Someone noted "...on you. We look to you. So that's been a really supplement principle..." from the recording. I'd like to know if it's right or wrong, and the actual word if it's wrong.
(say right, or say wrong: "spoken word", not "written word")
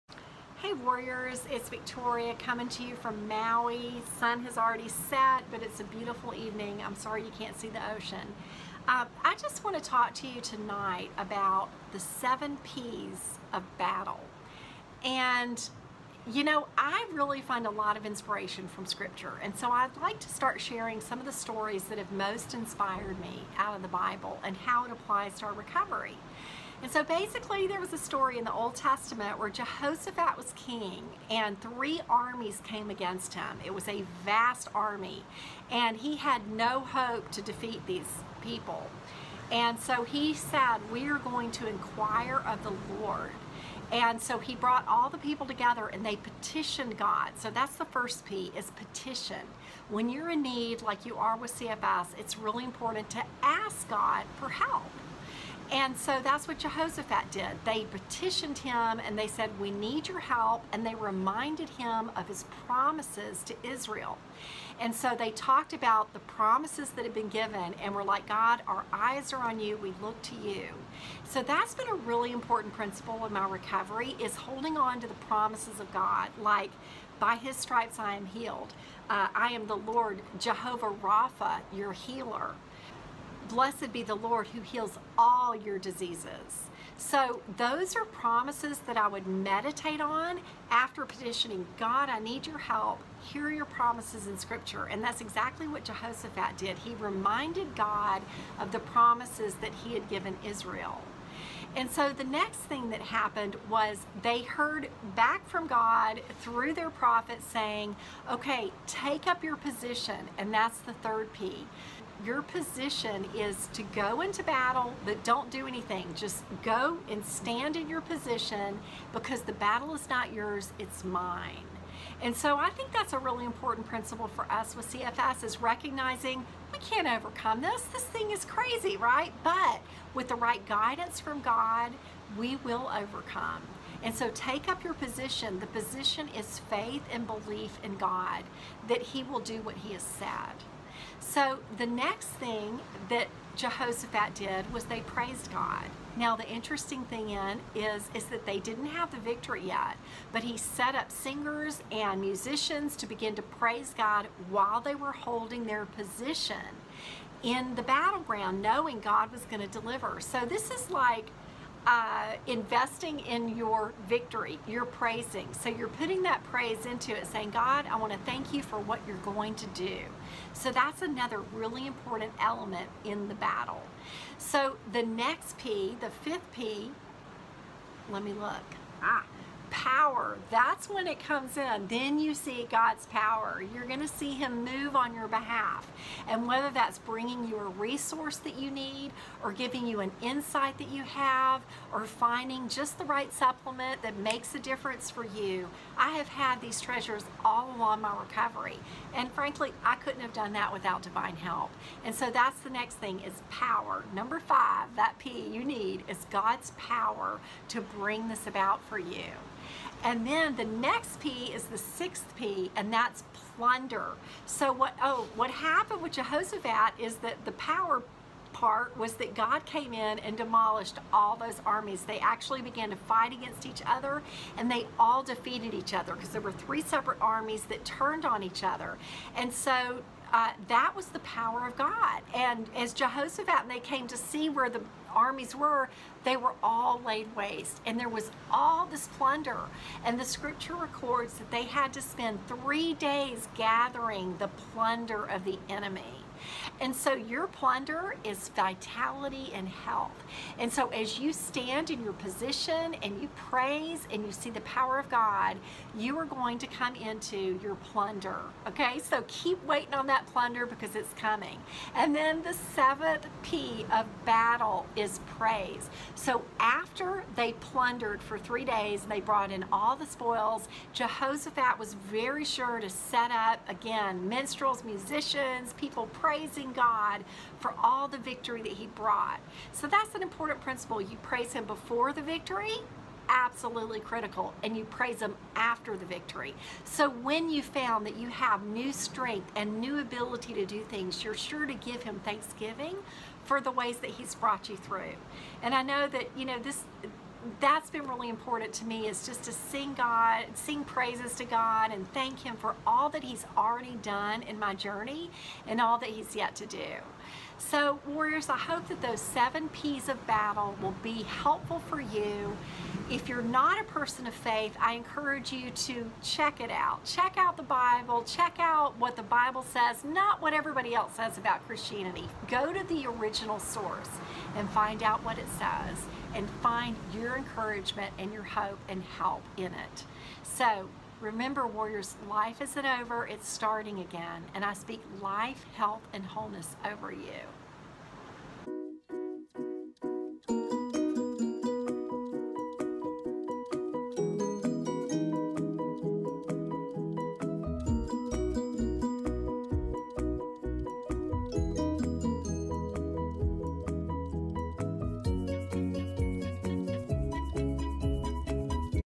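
wrong: "important", not "supplement".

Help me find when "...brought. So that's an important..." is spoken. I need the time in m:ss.
4:38.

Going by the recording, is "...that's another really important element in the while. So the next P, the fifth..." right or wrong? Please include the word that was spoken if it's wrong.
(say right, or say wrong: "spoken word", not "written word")
wrong: "battle", not "while".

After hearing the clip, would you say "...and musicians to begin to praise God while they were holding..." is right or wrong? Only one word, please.
right.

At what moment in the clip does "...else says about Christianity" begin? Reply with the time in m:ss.
5:20.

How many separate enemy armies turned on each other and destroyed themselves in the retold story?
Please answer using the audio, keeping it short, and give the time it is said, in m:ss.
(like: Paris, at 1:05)
3, at 3:46.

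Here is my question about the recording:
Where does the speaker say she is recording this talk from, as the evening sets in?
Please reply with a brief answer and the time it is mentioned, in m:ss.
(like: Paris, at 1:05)
Maui, at 0:03.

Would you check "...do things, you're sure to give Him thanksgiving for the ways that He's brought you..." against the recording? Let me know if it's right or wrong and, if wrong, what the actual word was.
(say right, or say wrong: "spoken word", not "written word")
right.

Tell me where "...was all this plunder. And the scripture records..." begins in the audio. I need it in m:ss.
3:58.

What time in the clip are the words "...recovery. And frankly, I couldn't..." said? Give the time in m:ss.
3:18.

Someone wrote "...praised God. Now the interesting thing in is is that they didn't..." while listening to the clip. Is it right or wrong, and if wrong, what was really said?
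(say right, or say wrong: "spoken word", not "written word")
right.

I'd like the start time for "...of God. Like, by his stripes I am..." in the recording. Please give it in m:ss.
1:15.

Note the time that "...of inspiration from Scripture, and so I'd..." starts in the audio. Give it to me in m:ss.
0:17.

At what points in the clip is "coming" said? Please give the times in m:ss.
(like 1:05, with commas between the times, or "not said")
0:02, 4:21.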